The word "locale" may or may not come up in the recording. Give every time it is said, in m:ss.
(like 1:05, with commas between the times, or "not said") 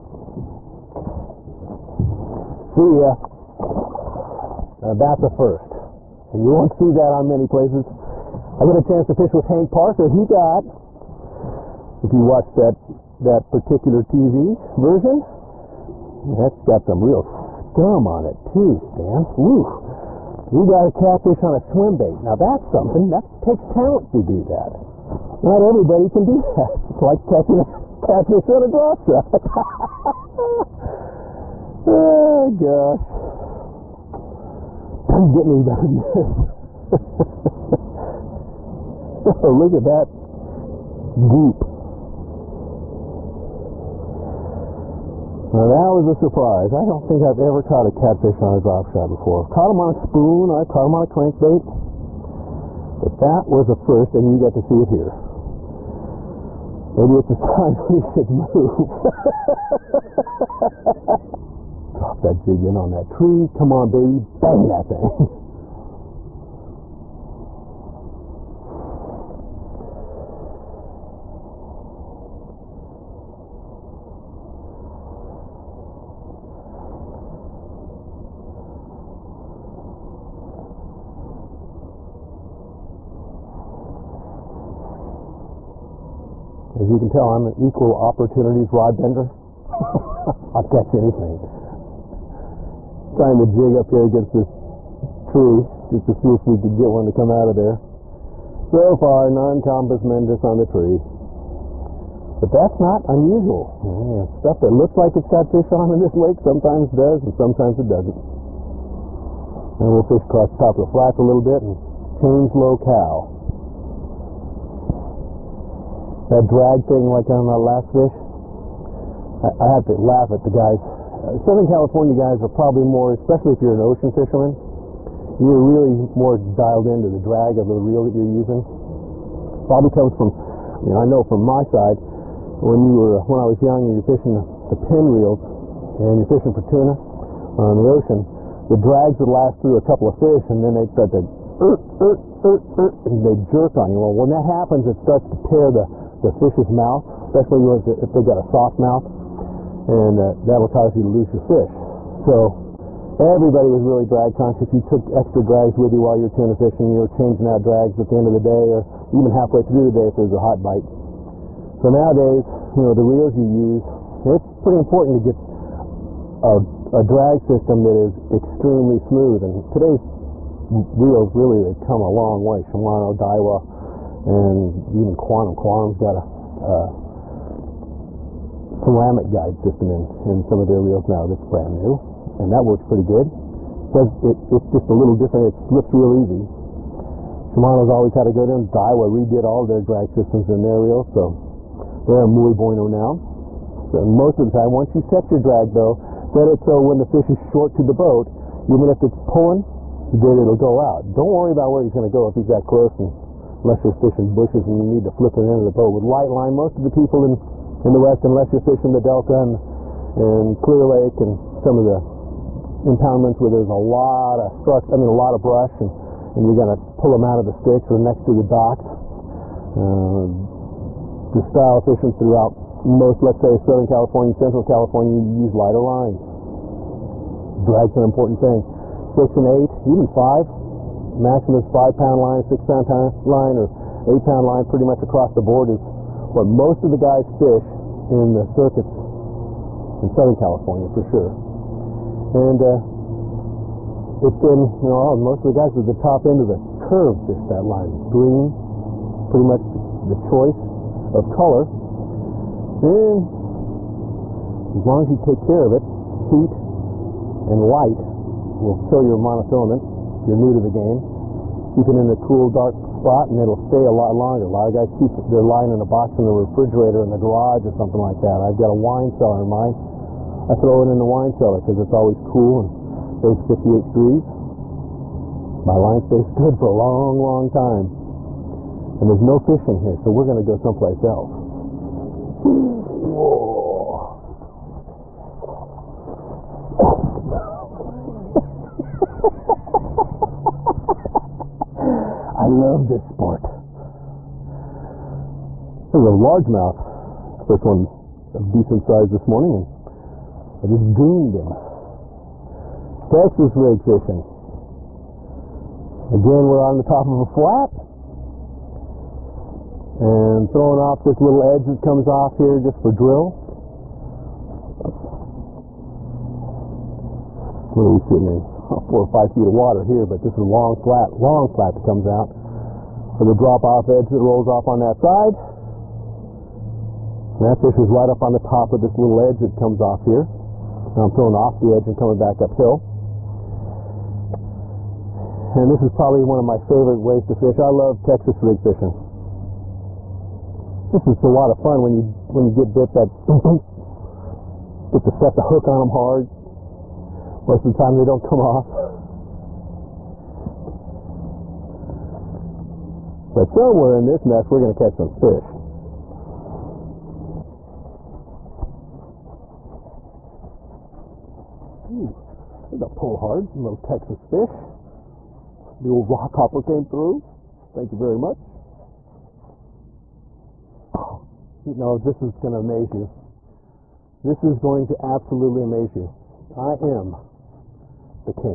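1:52.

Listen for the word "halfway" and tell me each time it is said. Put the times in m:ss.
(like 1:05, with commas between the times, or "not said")
2:39.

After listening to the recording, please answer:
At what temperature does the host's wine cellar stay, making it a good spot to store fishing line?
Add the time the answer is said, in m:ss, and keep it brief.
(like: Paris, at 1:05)
58 degrees, at 4:33.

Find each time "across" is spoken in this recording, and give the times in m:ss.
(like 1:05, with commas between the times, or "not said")
1:50, 3:55.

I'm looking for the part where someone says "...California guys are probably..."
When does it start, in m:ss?
2:01.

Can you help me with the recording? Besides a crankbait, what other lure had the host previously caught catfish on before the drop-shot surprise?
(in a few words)
spoon.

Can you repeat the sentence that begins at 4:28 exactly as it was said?
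I've got a wine cellar in mine.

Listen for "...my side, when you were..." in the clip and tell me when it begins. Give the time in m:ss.
2:11.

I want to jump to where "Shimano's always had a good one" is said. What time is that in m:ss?
3:07.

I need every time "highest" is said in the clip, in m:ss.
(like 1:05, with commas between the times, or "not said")
not said.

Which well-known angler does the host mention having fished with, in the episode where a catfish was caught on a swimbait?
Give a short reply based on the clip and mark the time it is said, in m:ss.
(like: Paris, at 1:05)
Hank Parker, at 0:09.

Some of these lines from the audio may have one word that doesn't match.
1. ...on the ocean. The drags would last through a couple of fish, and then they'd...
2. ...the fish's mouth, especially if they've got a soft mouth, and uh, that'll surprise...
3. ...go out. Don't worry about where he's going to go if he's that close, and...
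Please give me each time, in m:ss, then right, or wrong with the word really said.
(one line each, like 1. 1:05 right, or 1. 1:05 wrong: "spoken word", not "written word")
1. 2:17 right
2. 2:26 wrong: "cause", not "surprise"
3. 3:20 right.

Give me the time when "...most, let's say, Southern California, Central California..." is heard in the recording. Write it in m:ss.
3:42.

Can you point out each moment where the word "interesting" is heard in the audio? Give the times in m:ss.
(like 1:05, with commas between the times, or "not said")
not said.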